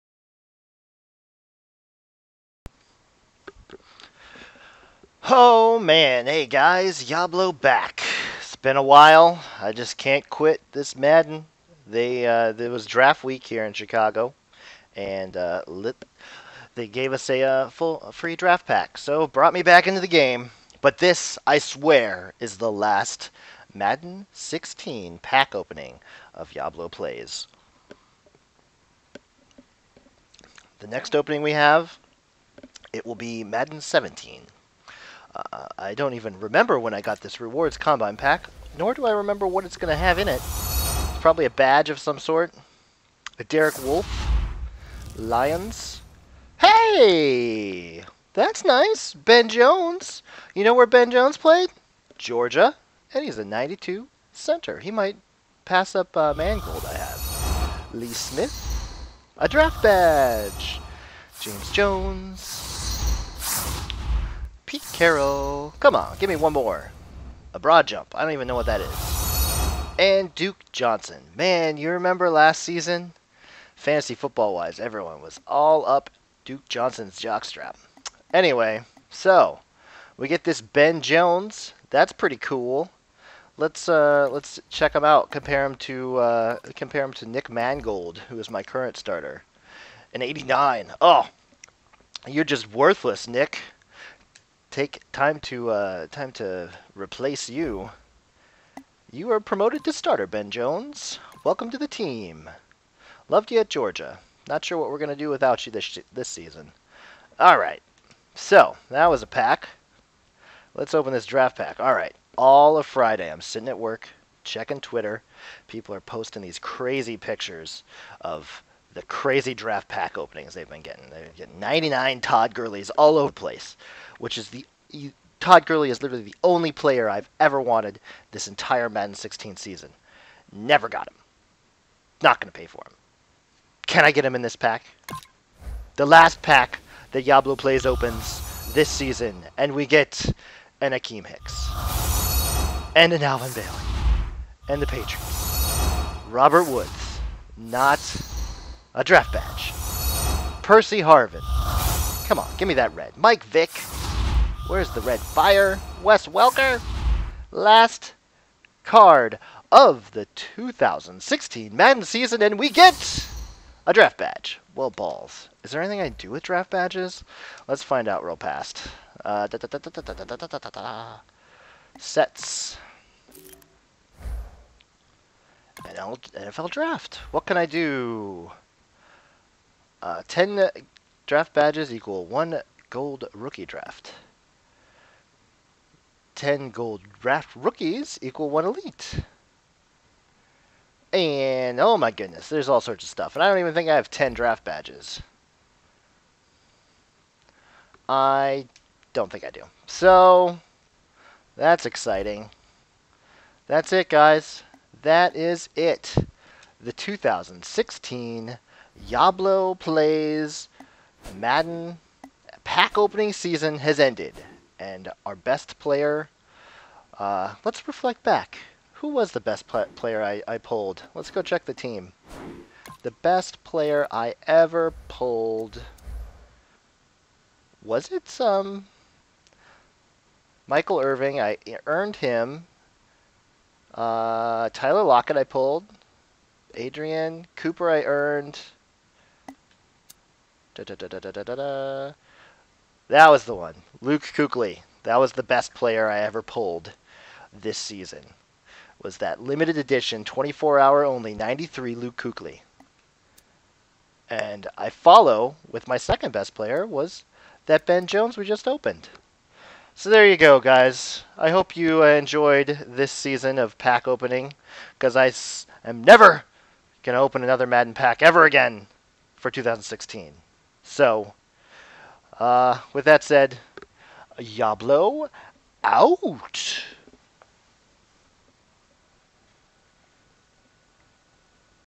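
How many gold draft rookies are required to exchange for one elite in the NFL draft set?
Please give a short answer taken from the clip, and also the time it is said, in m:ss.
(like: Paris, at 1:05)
10, at 3:06.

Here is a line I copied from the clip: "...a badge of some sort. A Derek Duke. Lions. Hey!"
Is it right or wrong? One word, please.
wrong.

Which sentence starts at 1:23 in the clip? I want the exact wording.
Let's uh, let's check him out.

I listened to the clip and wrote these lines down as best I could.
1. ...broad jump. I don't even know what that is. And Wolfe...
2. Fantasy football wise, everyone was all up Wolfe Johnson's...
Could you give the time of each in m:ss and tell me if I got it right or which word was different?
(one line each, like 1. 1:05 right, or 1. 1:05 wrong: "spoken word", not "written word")
1. 1:07 wrong: "Duke", not "Wolfe"
2. 1:13 wrong: "Duke", not "Wolfe".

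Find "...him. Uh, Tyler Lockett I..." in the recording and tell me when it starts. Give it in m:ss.
3:52.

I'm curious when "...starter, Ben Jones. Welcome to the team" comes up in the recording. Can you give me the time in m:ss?
1:39.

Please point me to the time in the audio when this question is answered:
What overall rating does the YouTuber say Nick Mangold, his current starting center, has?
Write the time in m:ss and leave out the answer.
1:30.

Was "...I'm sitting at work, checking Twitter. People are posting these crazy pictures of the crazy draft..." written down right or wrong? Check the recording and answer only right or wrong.
right.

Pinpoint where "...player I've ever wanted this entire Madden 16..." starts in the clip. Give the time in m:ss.
2:06.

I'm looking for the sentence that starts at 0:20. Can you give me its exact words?
But this, I swear, is the last Madden 16 pack opening of Yablo plays.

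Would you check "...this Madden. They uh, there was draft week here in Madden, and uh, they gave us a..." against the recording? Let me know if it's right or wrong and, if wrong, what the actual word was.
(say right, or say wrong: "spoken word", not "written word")
wrong: "Chicago", not "Madden".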